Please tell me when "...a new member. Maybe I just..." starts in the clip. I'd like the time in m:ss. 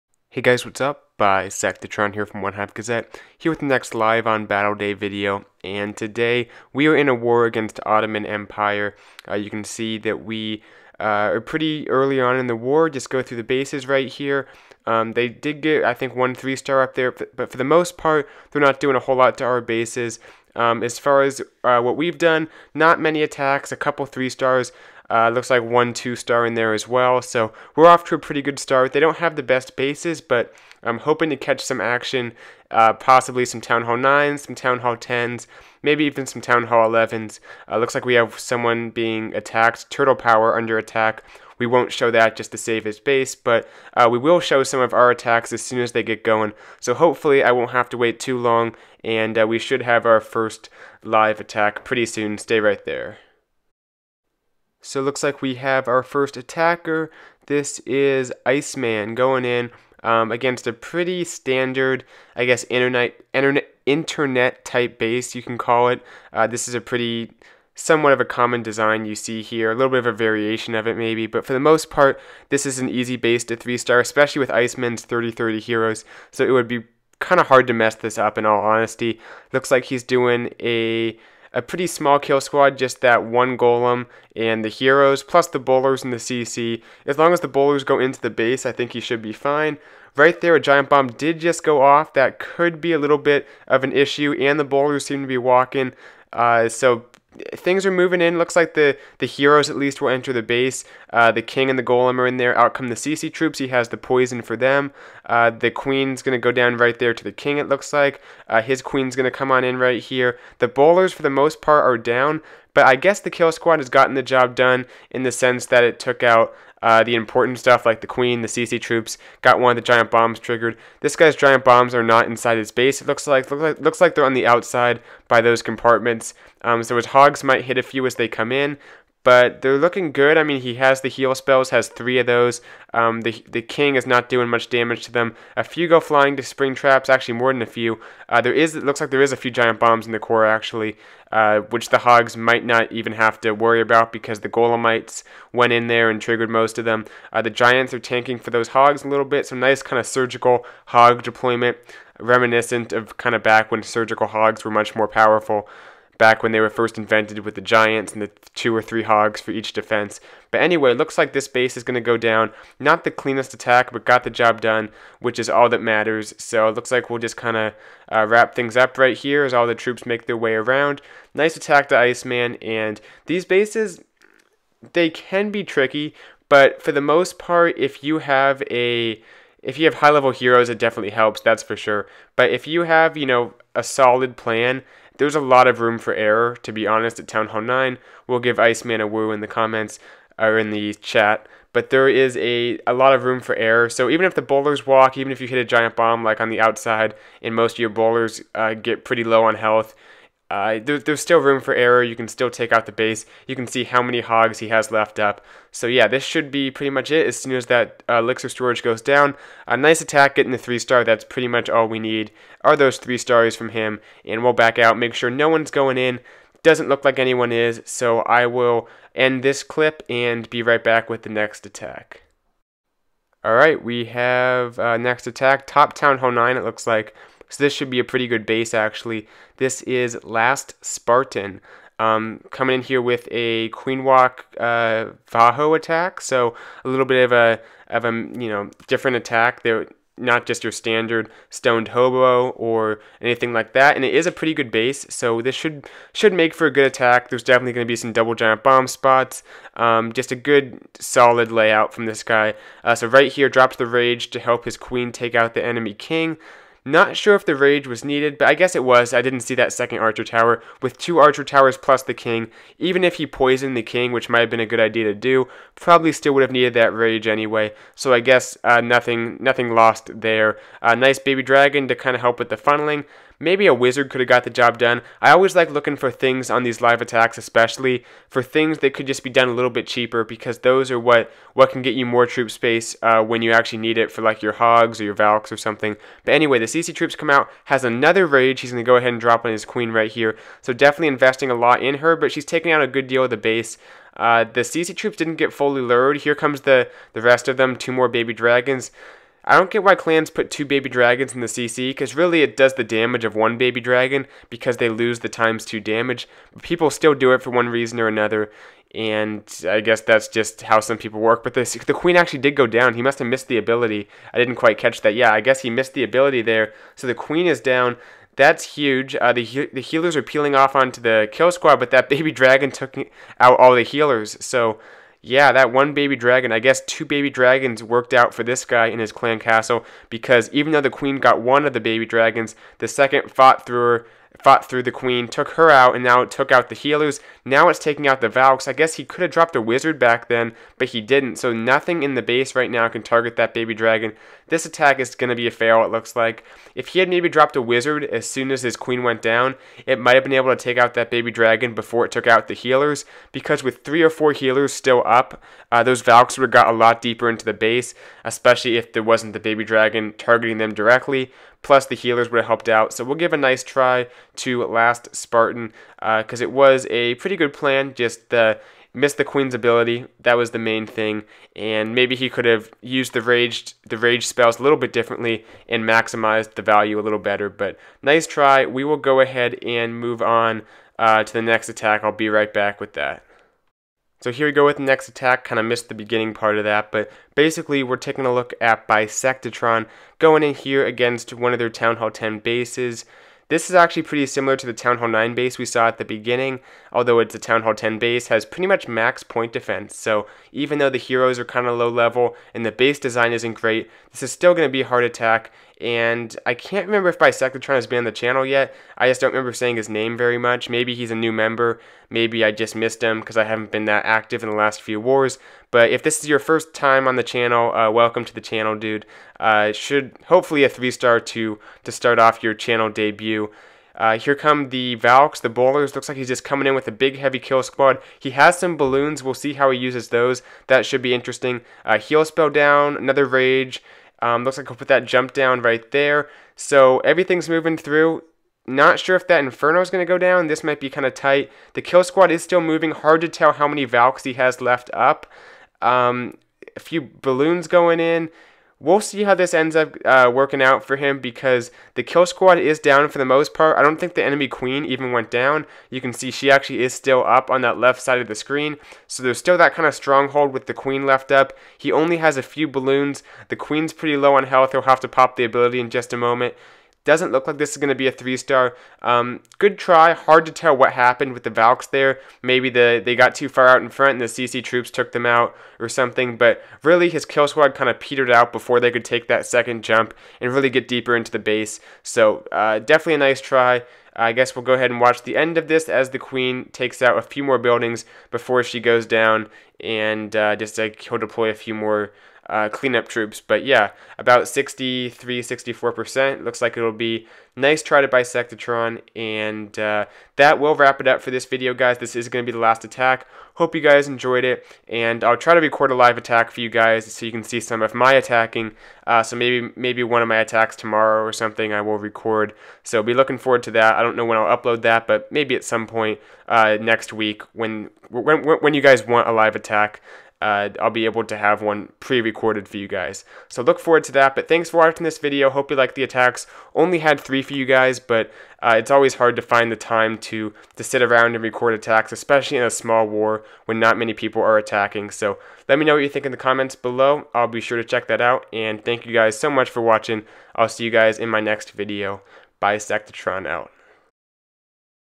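6:51.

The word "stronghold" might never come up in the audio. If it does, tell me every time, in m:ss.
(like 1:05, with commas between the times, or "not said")
7:39.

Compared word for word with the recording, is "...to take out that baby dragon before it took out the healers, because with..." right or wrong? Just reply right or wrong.
right.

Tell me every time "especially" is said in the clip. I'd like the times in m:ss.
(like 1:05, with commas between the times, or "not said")
1:14, 4:37, 5:58, 8:52.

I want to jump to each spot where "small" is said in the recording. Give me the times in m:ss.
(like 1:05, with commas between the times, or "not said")
1:21, 8:52.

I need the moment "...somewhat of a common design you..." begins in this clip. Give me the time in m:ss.
1:07.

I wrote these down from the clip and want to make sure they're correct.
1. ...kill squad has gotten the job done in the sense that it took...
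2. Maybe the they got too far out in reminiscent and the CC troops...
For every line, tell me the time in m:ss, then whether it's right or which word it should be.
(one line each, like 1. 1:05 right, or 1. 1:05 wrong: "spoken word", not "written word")
1. 1:53 right
2. 7:52 wrong: "front", not "reminiscent".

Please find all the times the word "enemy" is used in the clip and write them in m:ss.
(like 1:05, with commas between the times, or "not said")
4:15, 7:34.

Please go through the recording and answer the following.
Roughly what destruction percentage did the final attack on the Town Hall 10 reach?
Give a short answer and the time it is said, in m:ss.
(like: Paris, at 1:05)
63-64%, at 8:14.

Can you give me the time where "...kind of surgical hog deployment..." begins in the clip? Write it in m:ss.
2:29.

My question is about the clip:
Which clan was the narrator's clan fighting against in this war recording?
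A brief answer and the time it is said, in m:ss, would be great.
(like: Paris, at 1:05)
Ottoman Empire, at 0:07.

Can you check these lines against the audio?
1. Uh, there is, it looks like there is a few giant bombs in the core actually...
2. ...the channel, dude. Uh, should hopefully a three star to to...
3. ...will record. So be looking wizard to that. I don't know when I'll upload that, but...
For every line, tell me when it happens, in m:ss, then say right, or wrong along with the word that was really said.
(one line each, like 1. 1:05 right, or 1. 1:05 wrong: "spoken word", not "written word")
1. 2:18 right
2. 6:58 right
3. 8:31 wrong: "forward", not "wizard".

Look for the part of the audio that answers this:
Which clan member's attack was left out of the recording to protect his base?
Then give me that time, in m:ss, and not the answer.
0:39.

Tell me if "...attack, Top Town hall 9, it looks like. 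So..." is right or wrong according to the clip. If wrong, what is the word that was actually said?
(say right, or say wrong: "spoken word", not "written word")
right.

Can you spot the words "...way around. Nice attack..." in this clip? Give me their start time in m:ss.
2:50.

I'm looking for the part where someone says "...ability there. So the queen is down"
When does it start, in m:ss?
5:16.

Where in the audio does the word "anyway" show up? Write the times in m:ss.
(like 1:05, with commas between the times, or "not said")
2:40, 4:27, 4:46.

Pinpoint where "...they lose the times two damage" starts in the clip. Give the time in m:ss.
5:04.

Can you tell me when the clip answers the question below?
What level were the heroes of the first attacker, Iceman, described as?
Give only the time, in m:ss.
1:15.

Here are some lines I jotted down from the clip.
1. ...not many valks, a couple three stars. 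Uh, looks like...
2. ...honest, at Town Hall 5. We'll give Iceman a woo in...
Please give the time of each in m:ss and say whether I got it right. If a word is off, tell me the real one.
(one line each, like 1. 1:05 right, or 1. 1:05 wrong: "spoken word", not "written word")
1. 0:22 wrong: "attacks", not "valks"
2. 3:06 wrong: "9", not "5".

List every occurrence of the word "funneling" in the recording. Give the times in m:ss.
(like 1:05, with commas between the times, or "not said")
4:32.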